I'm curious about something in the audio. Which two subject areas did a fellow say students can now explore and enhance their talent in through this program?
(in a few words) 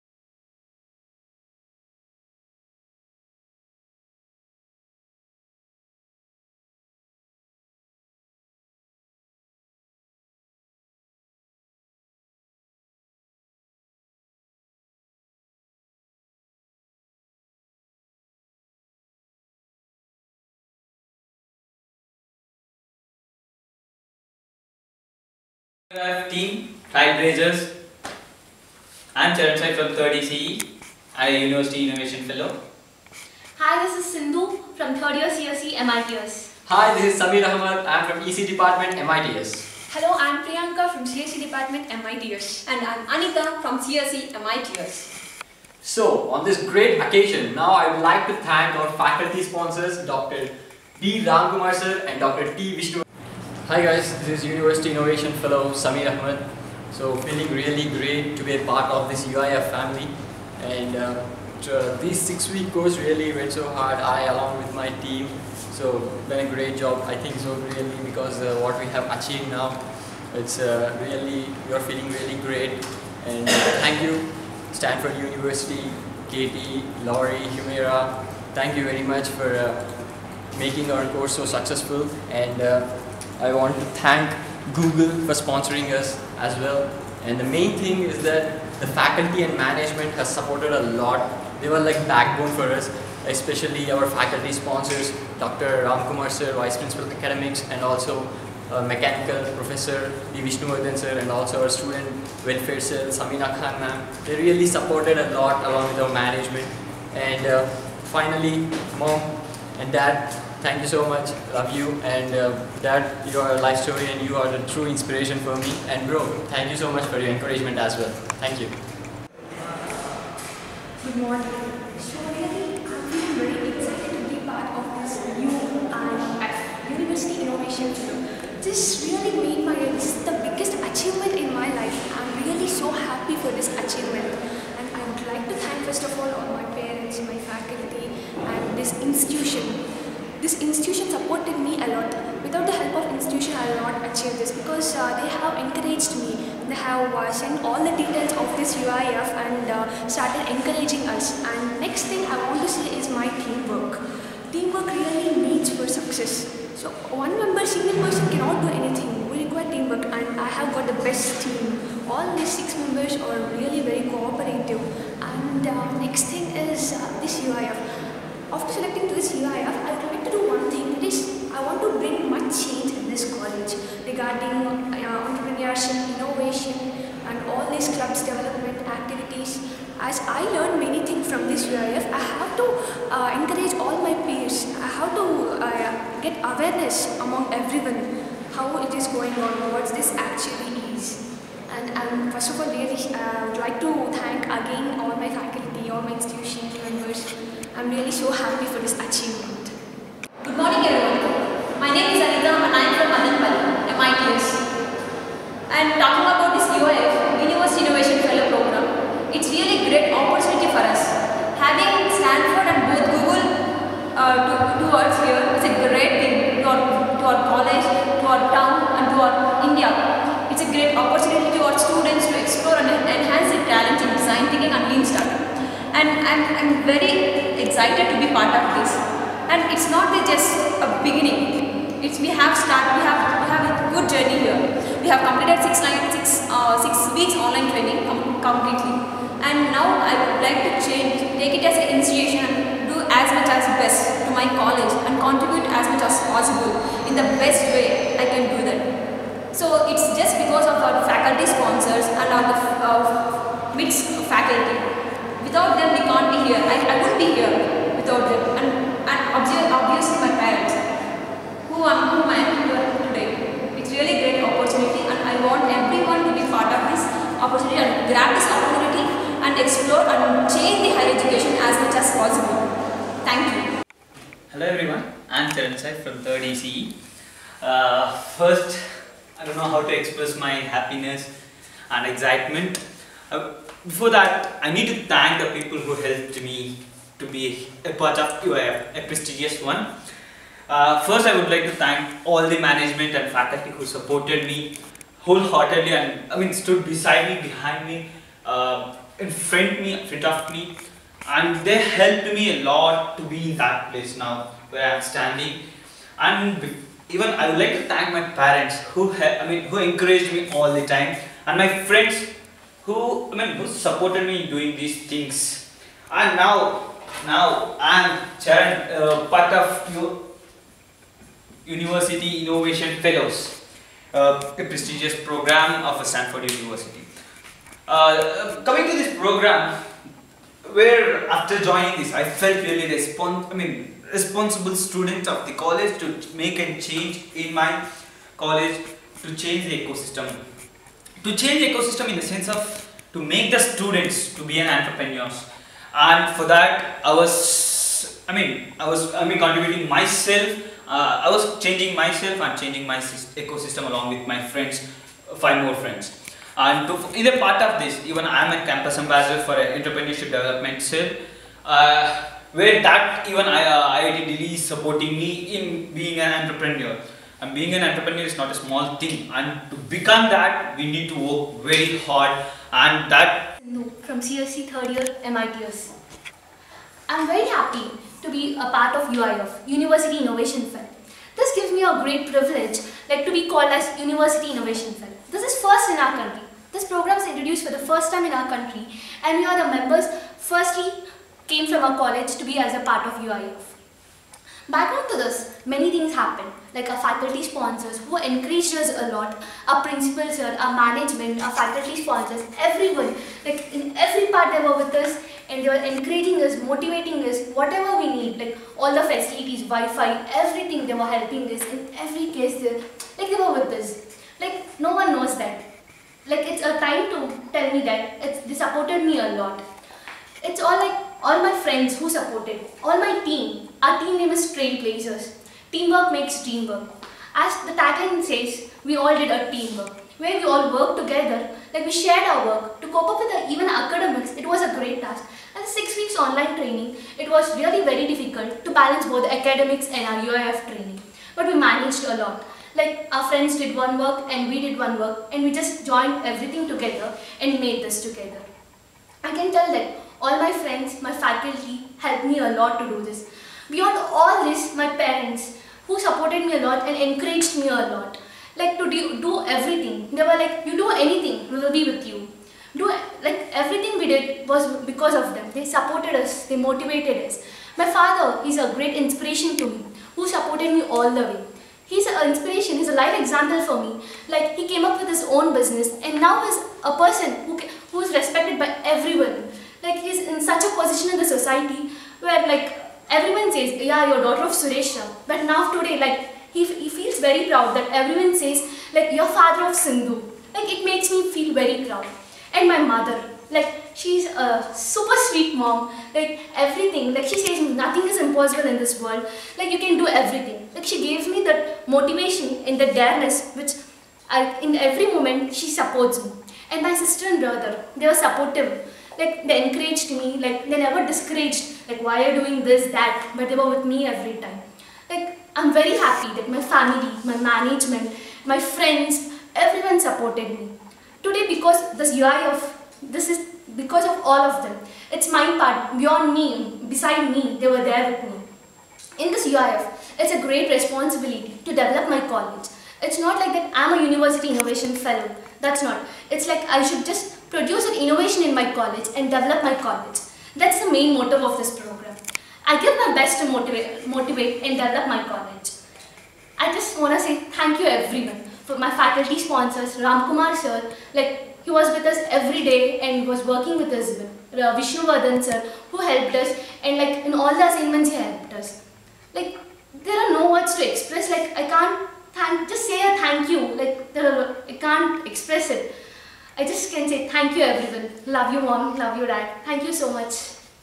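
design thinking and lean startup.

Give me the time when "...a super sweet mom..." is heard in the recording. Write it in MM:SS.
08:14.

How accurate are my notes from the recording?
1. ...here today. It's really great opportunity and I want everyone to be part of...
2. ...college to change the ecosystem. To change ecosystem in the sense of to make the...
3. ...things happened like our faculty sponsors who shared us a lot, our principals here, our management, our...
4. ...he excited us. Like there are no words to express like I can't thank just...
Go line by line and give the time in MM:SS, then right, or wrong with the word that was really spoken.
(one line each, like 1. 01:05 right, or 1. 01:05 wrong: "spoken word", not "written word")
1. 04:22 right
2. 05:38 right
3. 06:35 wrong: "encouraged", not "shared"
4. 09:18 wrong: "helped", not "excited".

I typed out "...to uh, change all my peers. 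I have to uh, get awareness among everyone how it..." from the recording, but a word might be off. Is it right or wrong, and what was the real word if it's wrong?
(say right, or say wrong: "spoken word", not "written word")
wrong: "encourage", not "change".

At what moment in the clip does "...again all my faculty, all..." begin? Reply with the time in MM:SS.
03:14.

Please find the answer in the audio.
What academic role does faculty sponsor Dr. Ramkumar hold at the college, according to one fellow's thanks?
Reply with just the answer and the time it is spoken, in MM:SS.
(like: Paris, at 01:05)
Vice Principal of Academics, at 01:36.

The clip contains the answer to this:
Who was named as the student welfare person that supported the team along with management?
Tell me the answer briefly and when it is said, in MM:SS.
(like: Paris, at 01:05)
Samina Khan, at 01:43.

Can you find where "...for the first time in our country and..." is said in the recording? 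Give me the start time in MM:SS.
06:27.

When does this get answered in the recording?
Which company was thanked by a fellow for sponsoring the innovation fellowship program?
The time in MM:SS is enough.
01:24.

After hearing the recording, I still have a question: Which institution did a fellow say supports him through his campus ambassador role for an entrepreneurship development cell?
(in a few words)
IIT Delhi.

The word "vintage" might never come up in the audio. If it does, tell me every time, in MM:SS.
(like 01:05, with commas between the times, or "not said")
not said.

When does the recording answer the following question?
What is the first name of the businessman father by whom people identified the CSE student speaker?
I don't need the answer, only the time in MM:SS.
08:04.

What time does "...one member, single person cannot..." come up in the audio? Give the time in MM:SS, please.
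02:37.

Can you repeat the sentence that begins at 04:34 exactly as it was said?
Hello everyone, I'm Charan from 3rd ECE.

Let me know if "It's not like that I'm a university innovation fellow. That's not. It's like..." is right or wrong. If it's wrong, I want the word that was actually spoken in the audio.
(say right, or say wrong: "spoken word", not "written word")
right.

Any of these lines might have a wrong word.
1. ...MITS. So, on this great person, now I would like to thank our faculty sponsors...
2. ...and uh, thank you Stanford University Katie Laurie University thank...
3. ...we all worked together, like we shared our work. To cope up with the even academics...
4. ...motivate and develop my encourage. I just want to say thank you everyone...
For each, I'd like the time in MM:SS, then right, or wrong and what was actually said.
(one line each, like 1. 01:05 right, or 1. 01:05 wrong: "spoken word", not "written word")
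1. 00:44 wrong: "occasion", not "person"
2. 01:13 wrong: "Humera", not "University"
3. 07:10 right
4. 09:04 wrong: "college", not "encourage".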